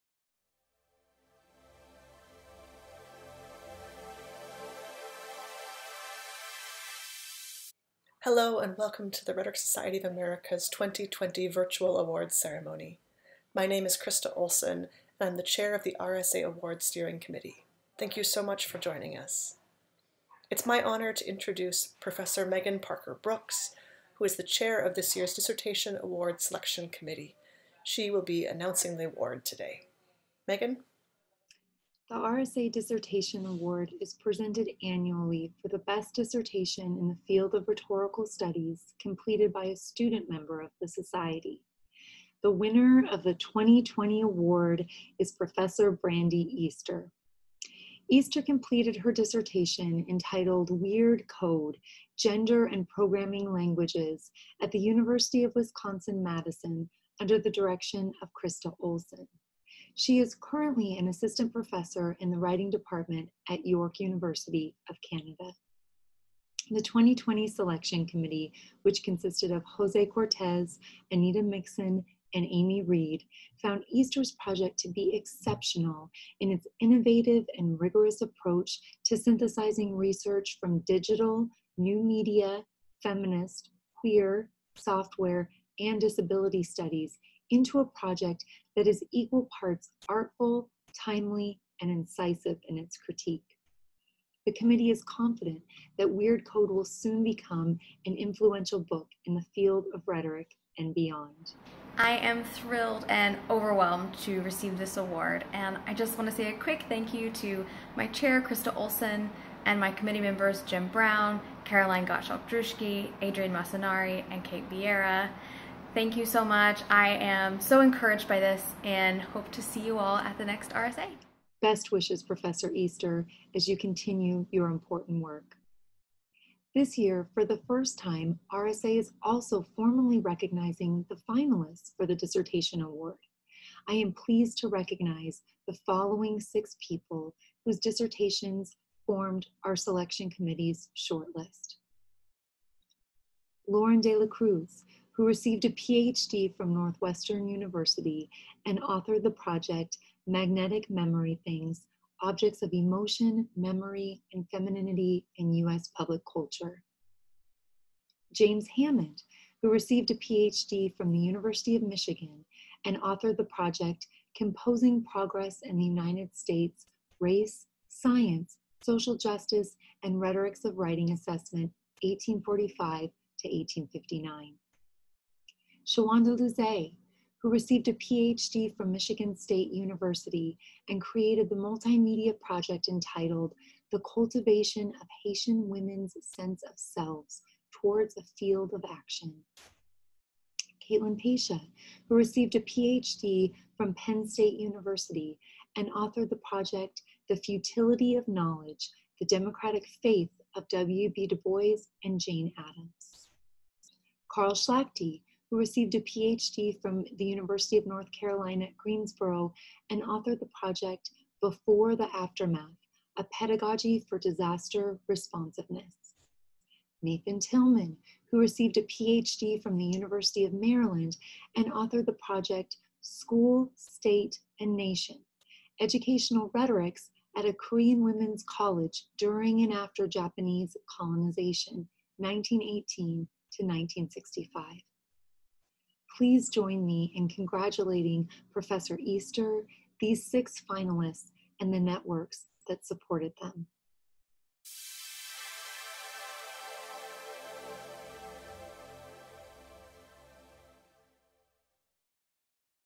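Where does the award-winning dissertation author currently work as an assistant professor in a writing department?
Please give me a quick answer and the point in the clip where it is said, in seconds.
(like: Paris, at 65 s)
York University, at 63 s.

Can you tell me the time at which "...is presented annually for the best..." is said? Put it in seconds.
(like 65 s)
34 s.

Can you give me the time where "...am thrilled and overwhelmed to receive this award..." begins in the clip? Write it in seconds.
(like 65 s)
102 s.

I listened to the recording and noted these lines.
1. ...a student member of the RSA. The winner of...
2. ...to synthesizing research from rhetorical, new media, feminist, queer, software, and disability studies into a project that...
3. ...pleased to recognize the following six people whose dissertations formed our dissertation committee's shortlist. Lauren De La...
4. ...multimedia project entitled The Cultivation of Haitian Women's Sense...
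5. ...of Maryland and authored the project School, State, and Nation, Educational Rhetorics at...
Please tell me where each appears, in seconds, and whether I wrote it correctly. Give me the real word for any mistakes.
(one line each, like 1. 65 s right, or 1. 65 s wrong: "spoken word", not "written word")
1. 39 s wrong: "Society", not "RSA"
2. 79 s wrong: "digital", not "rhetorical"
3. 134 s wrong: "selection", not "dissertation"
4. 181 s right
5. 220 s right.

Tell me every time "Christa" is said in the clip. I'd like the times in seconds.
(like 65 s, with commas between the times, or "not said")
13 s, 58 s, 108 s.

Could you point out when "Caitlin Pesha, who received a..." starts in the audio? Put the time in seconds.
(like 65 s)
190 s.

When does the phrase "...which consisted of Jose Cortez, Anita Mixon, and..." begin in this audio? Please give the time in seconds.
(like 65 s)
68 s.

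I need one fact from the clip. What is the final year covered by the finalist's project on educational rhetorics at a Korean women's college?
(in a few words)
1965.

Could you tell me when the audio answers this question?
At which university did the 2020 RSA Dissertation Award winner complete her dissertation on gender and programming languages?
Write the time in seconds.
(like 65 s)
54 s.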